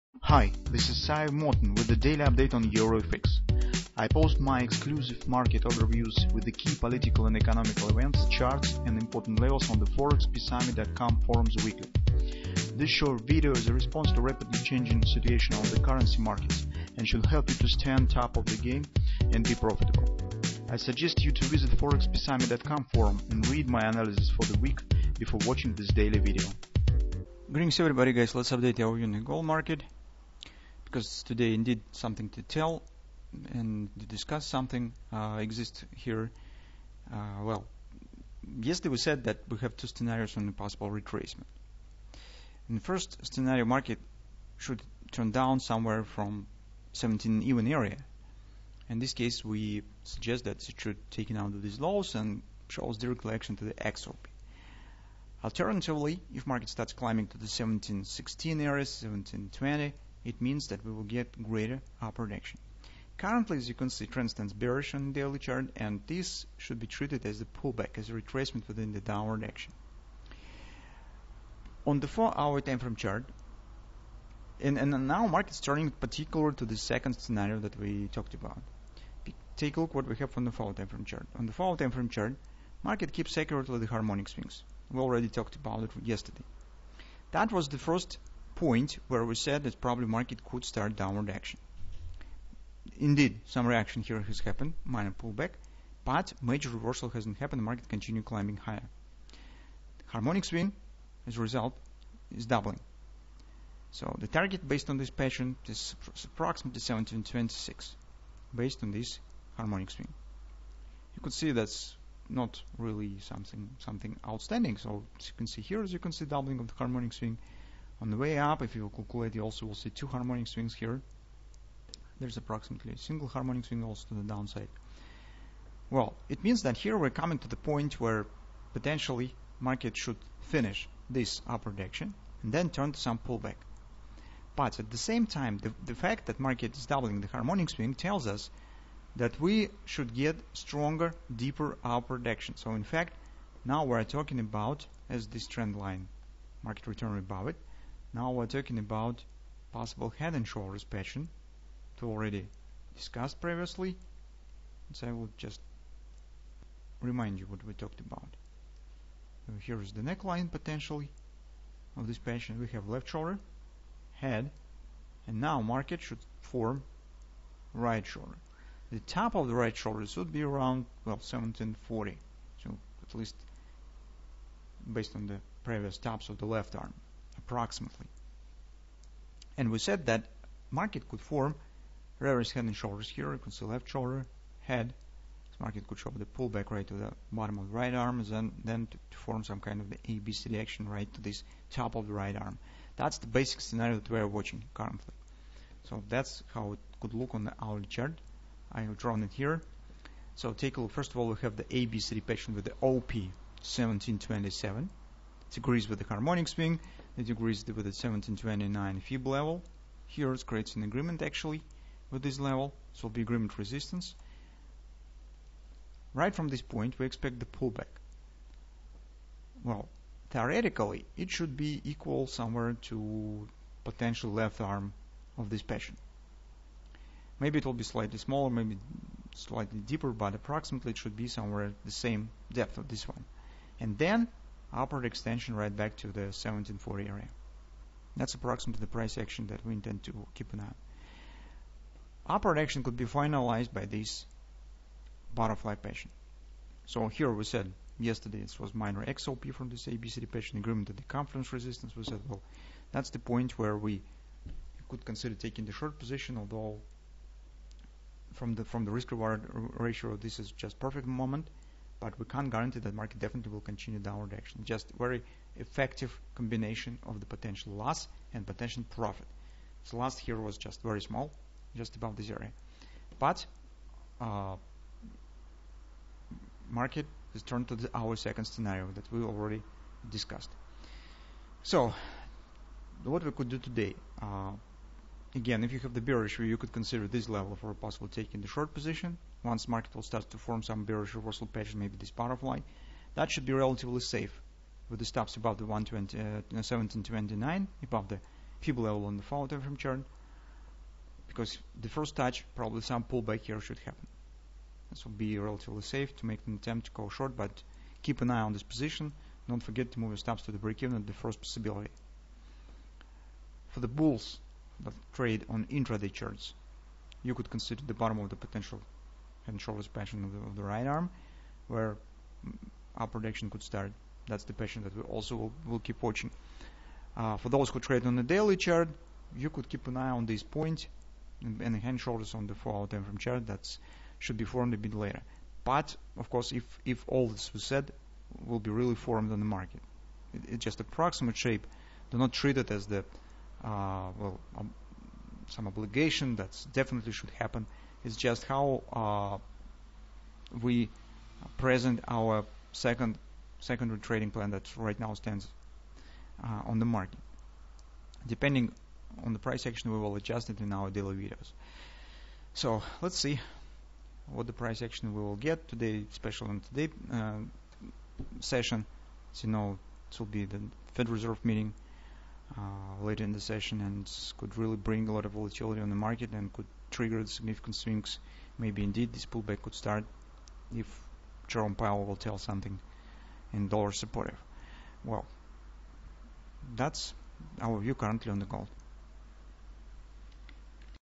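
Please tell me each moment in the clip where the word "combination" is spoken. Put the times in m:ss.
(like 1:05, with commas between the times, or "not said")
4:26.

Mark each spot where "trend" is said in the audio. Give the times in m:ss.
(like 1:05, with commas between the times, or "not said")
1:04, 2:25.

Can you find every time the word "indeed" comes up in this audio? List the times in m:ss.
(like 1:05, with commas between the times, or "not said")
0:31, 1:32, 6:18.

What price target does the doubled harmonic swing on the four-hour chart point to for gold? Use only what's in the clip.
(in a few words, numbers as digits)
1726.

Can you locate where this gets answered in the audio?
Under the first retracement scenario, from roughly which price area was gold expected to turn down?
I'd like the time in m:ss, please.
0:46.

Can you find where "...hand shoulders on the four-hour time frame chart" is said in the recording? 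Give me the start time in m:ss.
5:31.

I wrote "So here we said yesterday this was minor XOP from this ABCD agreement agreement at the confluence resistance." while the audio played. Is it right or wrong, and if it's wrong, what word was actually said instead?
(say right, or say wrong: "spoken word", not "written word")
wrong: "patient", not "agreement".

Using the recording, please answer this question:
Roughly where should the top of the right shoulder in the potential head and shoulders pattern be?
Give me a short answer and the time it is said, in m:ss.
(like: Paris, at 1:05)
1740, at 2:51.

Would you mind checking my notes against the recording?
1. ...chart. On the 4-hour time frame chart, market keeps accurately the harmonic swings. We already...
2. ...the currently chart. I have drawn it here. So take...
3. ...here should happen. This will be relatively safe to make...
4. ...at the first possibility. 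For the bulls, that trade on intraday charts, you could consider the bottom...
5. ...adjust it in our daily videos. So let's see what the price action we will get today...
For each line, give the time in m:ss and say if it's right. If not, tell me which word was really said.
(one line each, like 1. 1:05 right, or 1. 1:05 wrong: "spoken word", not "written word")
1. 1:21 right
2. 3:17 wrong: "hourly", not "currently"
3. 5:03 right
4. 5:10 right
5. 6:00 right.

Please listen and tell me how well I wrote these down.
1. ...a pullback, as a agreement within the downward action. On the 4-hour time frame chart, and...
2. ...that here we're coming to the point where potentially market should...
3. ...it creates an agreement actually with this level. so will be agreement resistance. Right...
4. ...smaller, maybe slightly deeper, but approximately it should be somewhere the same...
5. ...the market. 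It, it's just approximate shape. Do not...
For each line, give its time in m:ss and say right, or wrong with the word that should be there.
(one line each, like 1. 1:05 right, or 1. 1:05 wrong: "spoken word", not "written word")
1. 1:07 wrong: "retracement", not "agreement"
2. 2:06 right
3. 3:30 right
4. 3:48 right
5. 5:39 right.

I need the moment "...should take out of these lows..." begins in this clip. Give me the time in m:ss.
0:50.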